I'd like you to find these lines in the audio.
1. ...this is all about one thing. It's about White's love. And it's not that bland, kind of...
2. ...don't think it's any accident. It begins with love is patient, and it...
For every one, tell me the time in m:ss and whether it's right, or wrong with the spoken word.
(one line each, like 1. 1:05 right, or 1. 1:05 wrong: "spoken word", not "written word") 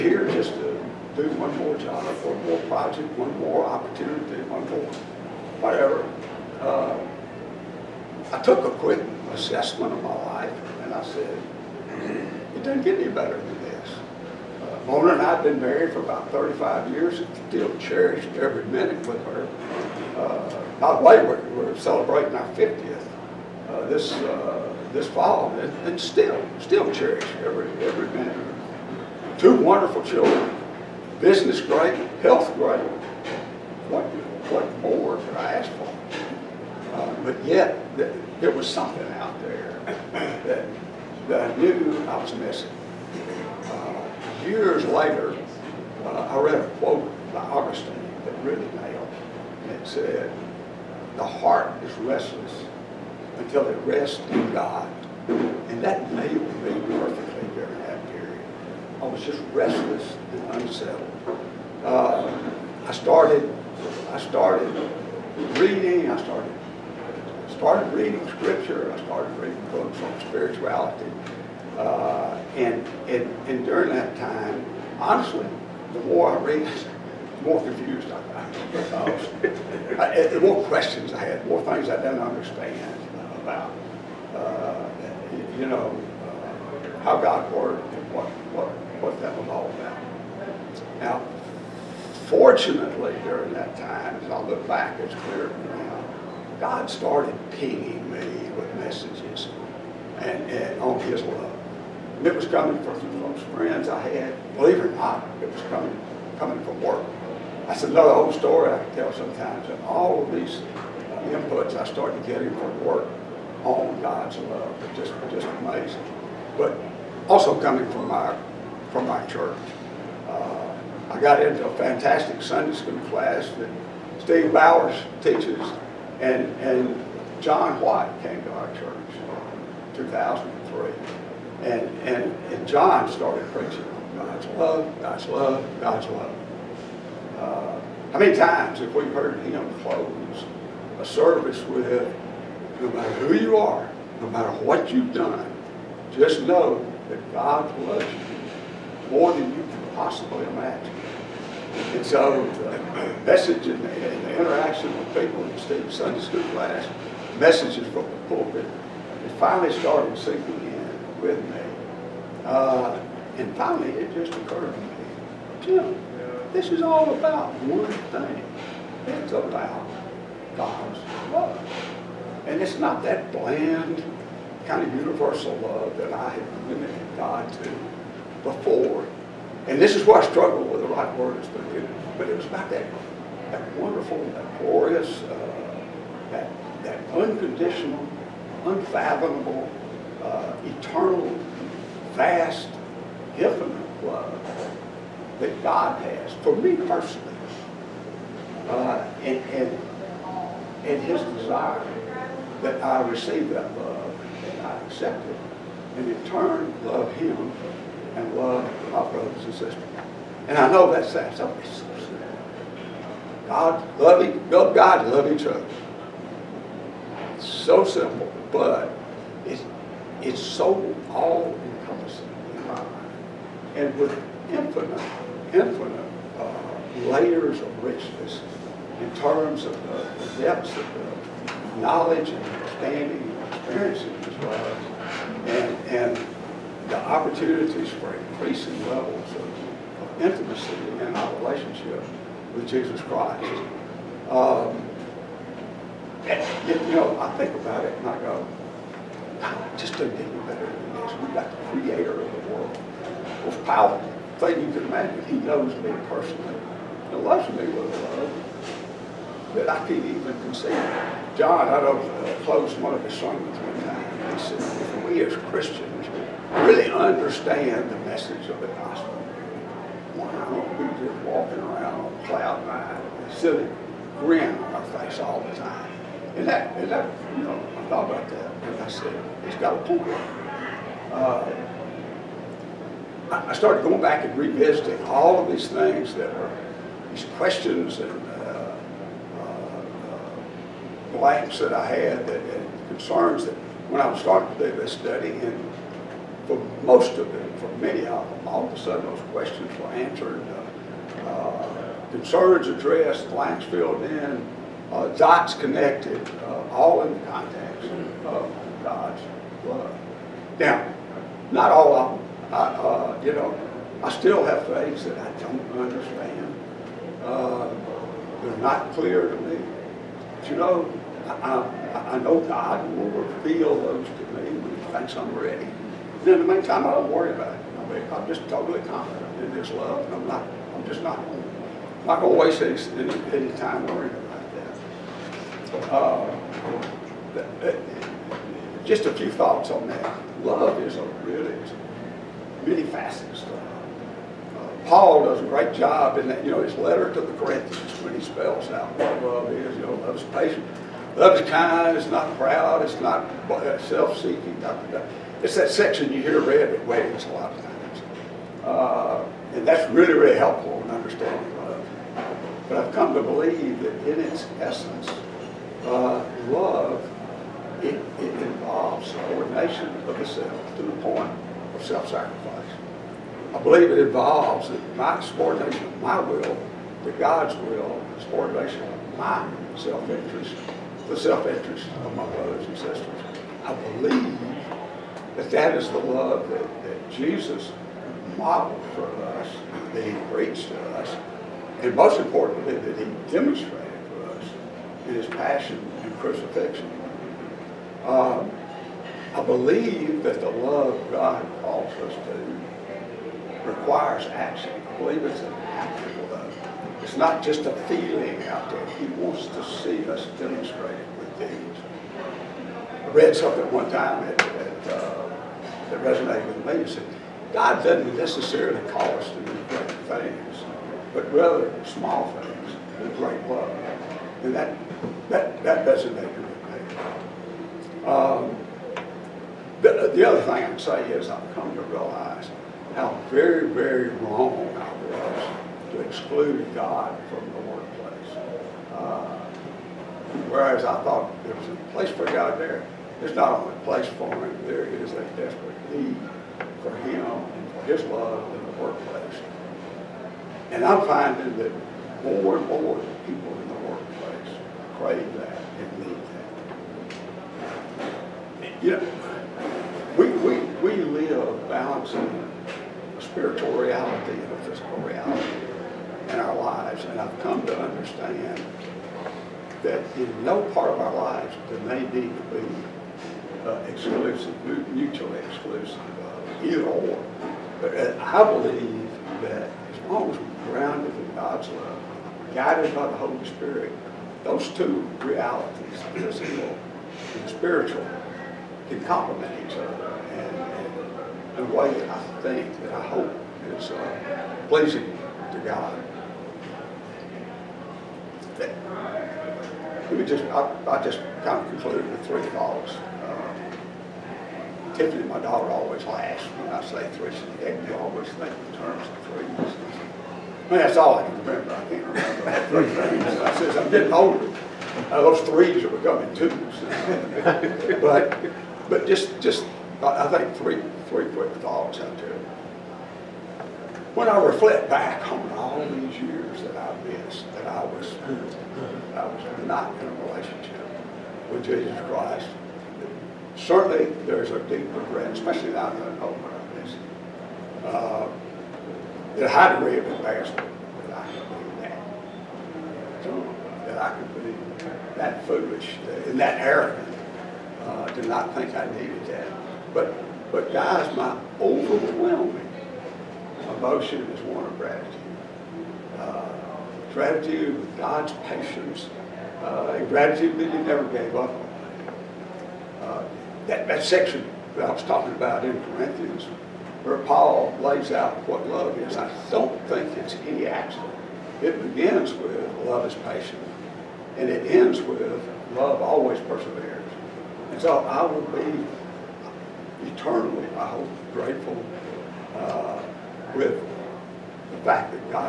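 1. 2:46 wrong: "God", not "White"
2. 9:29 right.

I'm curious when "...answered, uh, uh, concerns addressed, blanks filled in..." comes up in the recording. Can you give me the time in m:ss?
4:59.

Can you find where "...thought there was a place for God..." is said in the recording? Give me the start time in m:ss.
7:21.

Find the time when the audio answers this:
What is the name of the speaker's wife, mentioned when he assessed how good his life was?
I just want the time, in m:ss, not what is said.
0:14.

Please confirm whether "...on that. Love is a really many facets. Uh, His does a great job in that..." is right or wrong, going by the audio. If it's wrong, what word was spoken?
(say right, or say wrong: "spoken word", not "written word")
wrong: "Paul", not "His".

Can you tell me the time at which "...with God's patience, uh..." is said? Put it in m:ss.
9:17.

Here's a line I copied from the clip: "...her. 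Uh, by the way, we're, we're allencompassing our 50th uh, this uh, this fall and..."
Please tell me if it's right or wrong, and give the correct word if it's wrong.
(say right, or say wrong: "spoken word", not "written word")
wrong: "celebrating", not "allencompassing".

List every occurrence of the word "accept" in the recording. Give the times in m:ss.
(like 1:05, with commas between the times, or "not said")
3:24.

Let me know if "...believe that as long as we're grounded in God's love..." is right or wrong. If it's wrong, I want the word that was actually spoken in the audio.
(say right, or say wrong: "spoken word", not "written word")
right.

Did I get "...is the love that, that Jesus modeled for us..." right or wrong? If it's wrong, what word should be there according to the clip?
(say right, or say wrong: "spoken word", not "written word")
right.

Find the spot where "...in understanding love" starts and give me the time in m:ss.
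6:00.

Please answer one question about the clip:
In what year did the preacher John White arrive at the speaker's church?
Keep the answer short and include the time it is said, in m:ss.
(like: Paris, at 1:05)
2003, at 2:09.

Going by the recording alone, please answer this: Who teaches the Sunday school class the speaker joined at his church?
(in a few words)
Steve Bowers.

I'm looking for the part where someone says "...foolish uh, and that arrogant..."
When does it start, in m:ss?
9:05.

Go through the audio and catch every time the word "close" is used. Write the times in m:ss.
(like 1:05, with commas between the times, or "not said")
2:19, 4:22.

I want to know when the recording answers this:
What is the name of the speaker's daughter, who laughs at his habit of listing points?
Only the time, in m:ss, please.
8:24.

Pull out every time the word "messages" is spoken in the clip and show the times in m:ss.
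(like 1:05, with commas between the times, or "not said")
1:38, 2:33, 2:37, 4:27.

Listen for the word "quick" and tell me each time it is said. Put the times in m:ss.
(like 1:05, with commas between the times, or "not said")
0:08, 8:41.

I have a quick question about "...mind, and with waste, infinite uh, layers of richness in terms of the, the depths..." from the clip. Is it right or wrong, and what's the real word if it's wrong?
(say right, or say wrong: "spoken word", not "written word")
wrong: "infinite", not "waste".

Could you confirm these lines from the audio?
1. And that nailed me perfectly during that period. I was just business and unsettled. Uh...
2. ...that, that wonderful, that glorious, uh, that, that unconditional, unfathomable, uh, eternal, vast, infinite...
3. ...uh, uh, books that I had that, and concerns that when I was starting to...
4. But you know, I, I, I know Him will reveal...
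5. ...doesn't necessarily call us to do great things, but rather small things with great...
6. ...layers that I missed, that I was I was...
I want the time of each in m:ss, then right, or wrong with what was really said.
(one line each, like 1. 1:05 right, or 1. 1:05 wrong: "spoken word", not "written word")
1. 0:55 wrong: "restless", not "business"
2. 3:02 right
3. 4:49 wrong: "blanks", not "books"
4. 5:20 wrong: "God", not "Him"
5. 6:57 right
6. 8:46 wrong: "years", not "layers".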